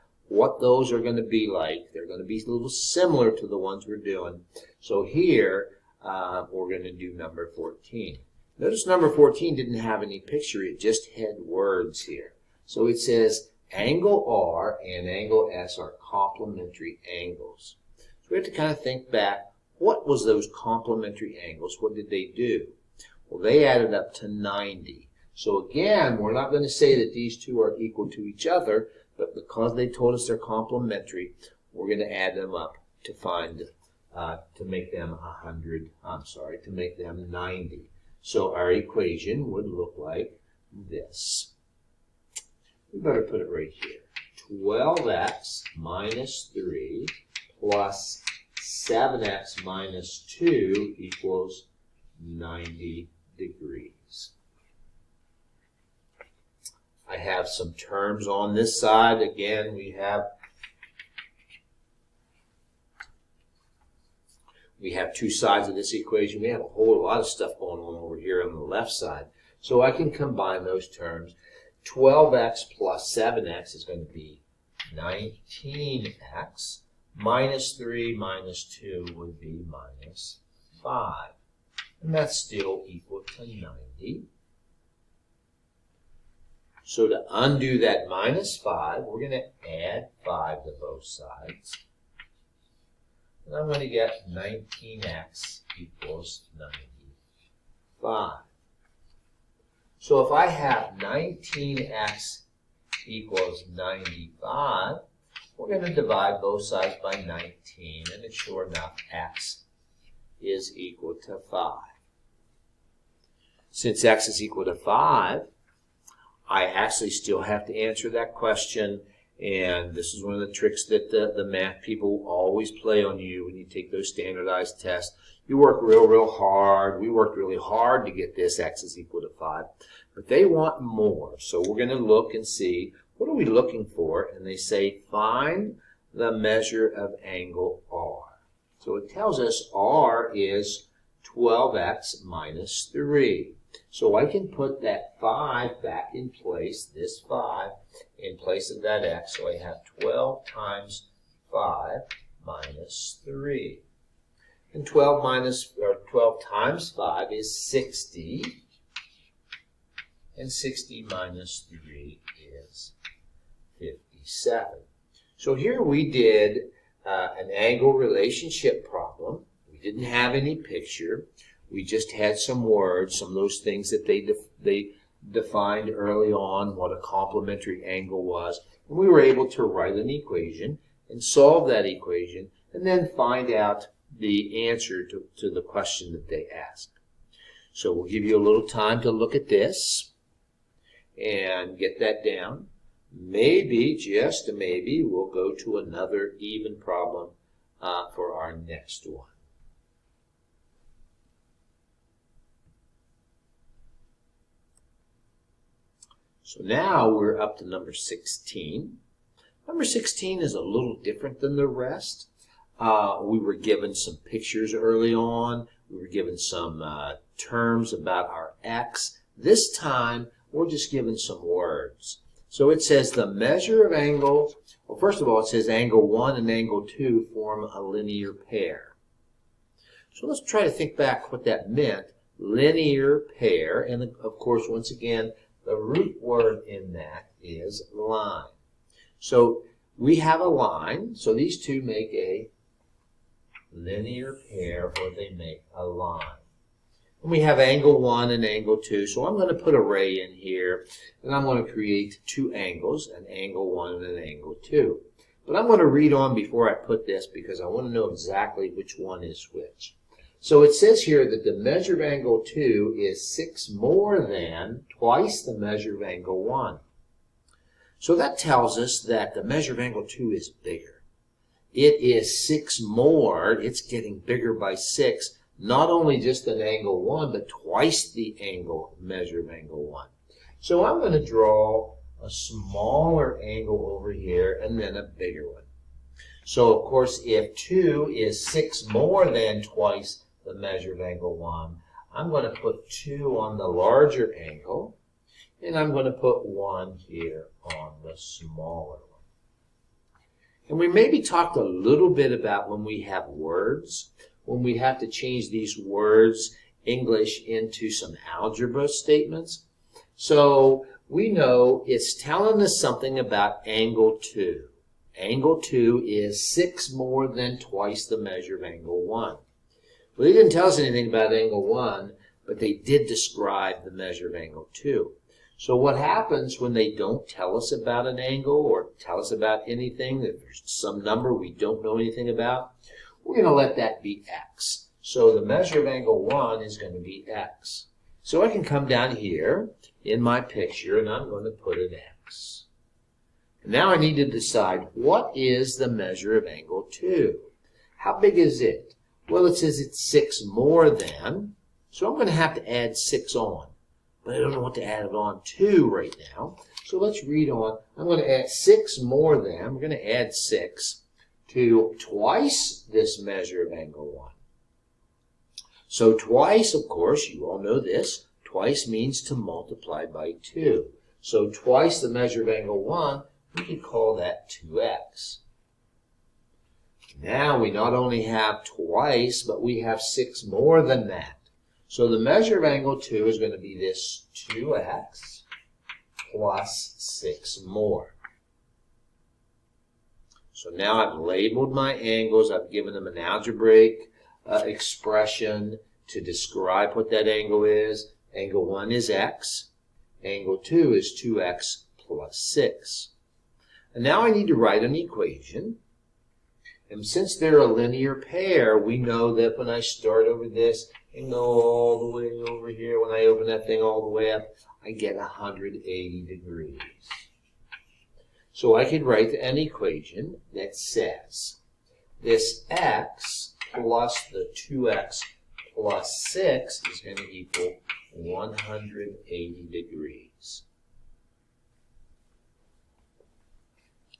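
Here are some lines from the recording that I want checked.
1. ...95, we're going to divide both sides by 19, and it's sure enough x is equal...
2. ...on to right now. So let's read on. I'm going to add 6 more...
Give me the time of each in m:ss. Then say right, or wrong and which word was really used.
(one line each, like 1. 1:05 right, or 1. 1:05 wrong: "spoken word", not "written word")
1. 1:43 right
2. 5:55 right.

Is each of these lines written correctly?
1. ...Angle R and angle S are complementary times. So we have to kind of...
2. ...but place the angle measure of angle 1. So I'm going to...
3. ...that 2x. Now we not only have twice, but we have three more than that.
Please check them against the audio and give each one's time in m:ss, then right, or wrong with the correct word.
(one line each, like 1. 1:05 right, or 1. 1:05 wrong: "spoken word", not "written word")
1. 0:13 wrong: "angles", not "times"
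2. 4:37 wrong: "twice", not "place"
3. 6:14 wrong: "six", not "three".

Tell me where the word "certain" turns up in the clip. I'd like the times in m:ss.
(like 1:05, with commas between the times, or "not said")
not said.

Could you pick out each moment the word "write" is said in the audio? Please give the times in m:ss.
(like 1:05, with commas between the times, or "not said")
2:59, 6:44, 6:59.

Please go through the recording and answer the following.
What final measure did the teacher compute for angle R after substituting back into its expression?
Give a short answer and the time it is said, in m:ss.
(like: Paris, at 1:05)
57, at 2:43.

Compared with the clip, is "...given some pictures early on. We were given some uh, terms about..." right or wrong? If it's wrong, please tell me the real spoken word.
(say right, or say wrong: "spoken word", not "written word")
right.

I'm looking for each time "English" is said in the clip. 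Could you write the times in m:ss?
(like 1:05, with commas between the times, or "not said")
5:06.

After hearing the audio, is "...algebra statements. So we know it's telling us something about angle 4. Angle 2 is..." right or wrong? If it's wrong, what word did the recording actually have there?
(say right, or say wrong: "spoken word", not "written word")
wrong: "2", not "4".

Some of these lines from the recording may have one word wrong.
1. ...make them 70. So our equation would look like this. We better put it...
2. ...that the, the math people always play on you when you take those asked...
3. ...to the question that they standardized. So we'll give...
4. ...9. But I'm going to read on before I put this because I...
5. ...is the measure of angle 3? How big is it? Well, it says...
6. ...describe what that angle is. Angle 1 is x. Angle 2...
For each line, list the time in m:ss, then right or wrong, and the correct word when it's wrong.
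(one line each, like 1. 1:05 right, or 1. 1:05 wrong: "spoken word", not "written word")
1. 0:36 wrong: "90", not "70"
2. 2:00 wrong: "standardized", not "asked"
3. 3:05 wrong: "asked", not "standardized"
4. 4:14 wrong: "2", not "9"
5. 5:45 wrong: "2", not "3"
6. 6:36 right.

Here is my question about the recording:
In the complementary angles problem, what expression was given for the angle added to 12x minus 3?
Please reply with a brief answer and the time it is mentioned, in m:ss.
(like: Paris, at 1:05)
7x - 2, at 0:48.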